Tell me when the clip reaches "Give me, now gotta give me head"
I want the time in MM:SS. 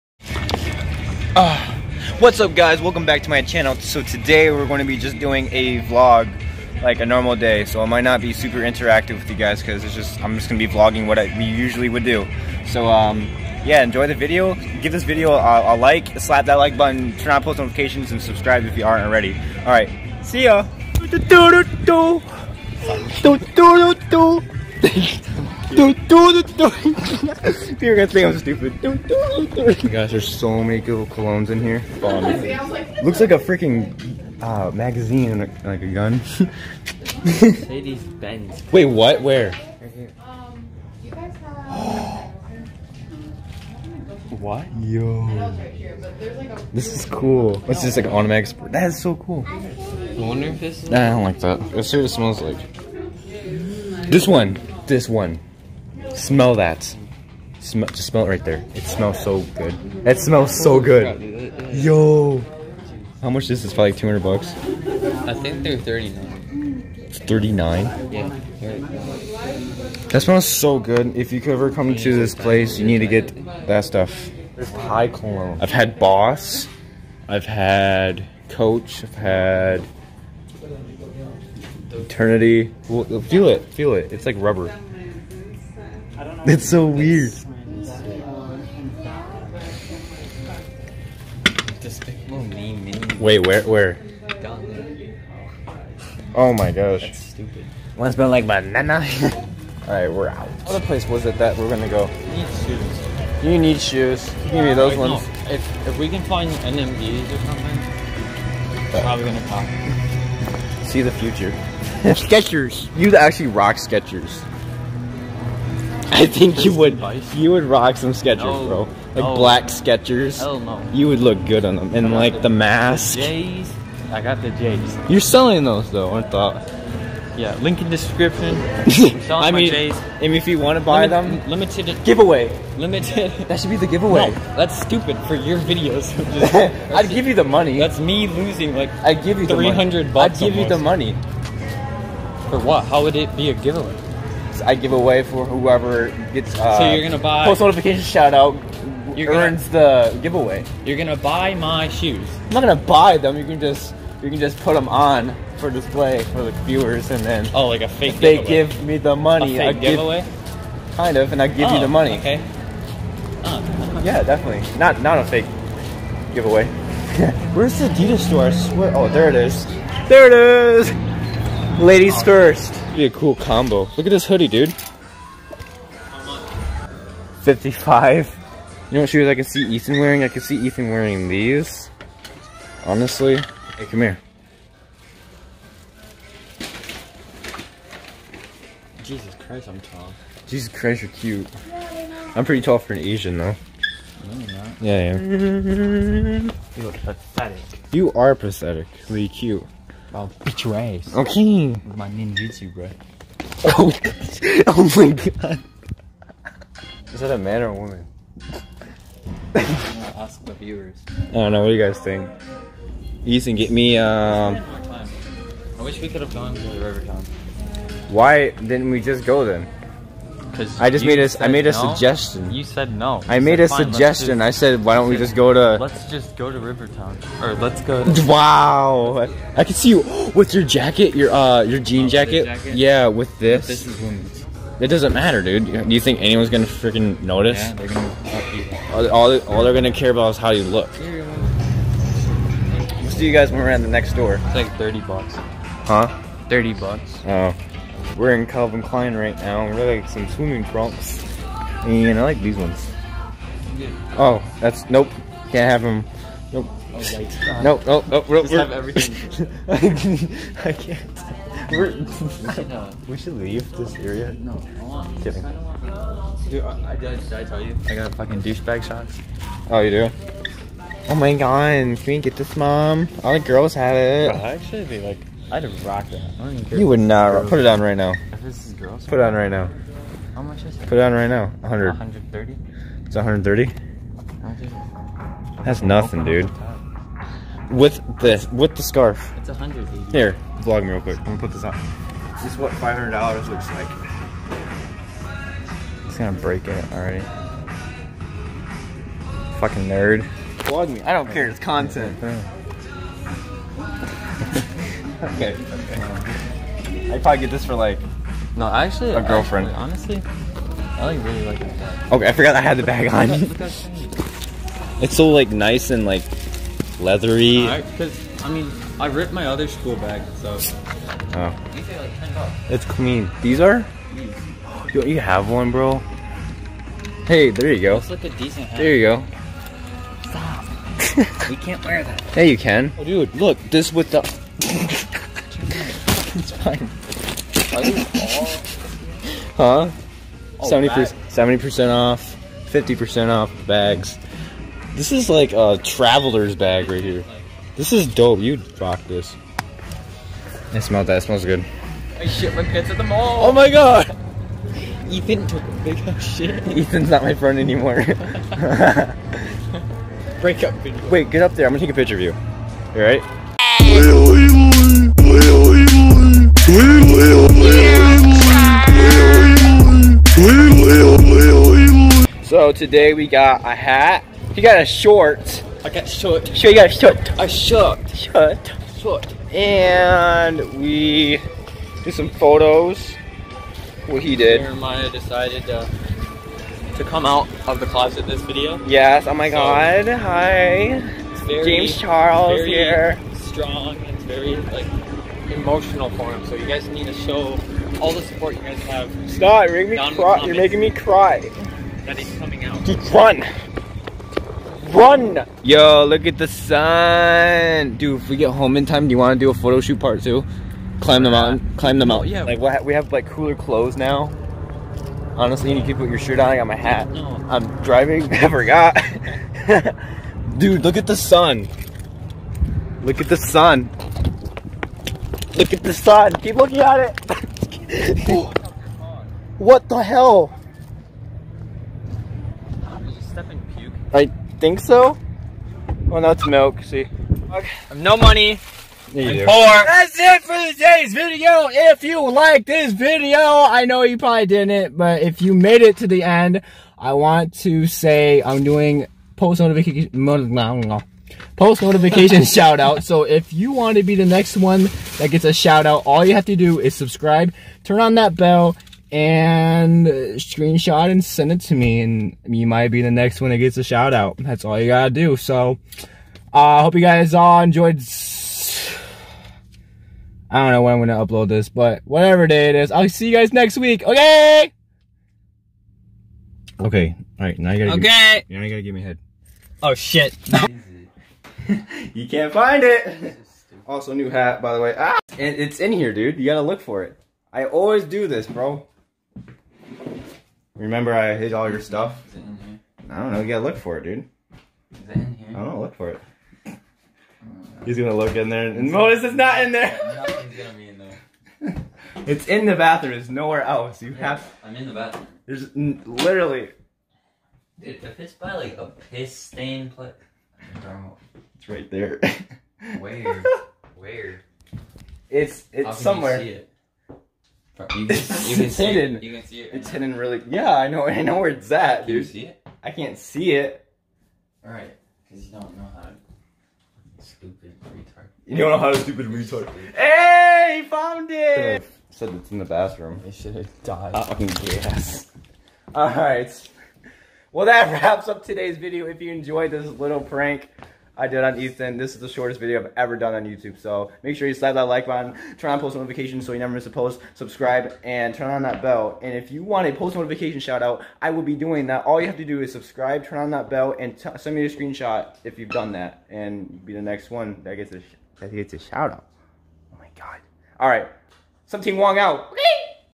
07:58.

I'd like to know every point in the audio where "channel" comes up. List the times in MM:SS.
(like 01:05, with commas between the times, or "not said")
00:03.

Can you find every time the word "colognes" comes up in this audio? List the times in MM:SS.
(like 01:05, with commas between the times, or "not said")
00:31, 01:15.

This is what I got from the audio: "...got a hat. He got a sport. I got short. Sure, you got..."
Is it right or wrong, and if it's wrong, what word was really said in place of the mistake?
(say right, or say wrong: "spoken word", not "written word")
wrong: "short", not "sport".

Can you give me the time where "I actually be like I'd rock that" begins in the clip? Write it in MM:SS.
04:34.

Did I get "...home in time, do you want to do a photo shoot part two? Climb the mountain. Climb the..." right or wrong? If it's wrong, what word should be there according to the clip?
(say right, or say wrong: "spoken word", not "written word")
right.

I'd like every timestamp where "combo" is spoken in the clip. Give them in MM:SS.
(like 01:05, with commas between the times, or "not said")
02:53.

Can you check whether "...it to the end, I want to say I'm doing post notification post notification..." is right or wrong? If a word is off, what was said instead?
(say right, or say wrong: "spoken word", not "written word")
right.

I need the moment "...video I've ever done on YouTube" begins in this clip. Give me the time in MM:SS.
09:02.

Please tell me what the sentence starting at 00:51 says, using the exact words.
Let's see what it smells like.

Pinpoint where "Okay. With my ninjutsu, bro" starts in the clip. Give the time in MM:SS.
03:21.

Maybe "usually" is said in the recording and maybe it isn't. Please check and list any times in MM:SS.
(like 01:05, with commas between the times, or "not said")
00:11.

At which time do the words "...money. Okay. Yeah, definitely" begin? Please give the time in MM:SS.
02:41.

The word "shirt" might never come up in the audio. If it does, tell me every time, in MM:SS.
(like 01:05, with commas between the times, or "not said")
06:56.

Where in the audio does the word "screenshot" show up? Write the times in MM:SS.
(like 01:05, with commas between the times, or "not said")
07:40, 09:14.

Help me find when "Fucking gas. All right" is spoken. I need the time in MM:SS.
08:54.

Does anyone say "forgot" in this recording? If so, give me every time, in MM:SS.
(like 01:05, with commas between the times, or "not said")
05:12, 06:58.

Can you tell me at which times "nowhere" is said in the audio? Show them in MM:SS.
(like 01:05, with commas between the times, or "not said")
08:23.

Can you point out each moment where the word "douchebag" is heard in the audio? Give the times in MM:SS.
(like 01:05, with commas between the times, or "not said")
04:28.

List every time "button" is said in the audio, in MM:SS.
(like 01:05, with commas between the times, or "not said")
00:16, 09:05.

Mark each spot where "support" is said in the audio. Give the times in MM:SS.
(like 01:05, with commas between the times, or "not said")
06:38.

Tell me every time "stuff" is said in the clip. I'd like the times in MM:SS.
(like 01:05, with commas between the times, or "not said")
01:13, 08:11.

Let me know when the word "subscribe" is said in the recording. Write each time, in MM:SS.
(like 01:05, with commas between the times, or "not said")
00:18, 07:36, 09:07, 09:12.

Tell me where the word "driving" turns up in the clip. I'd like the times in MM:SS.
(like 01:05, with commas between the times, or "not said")
06:57.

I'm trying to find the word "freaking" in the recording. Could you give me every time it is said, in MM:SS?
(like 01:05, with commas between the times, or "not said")
00:33, 03:56.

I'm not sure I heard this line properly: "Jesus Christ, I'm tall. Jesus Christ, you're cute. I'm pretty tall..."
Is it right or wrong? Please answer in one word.
right.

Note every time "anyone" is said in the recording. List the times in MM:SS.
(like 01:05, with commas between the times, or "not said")
03:56.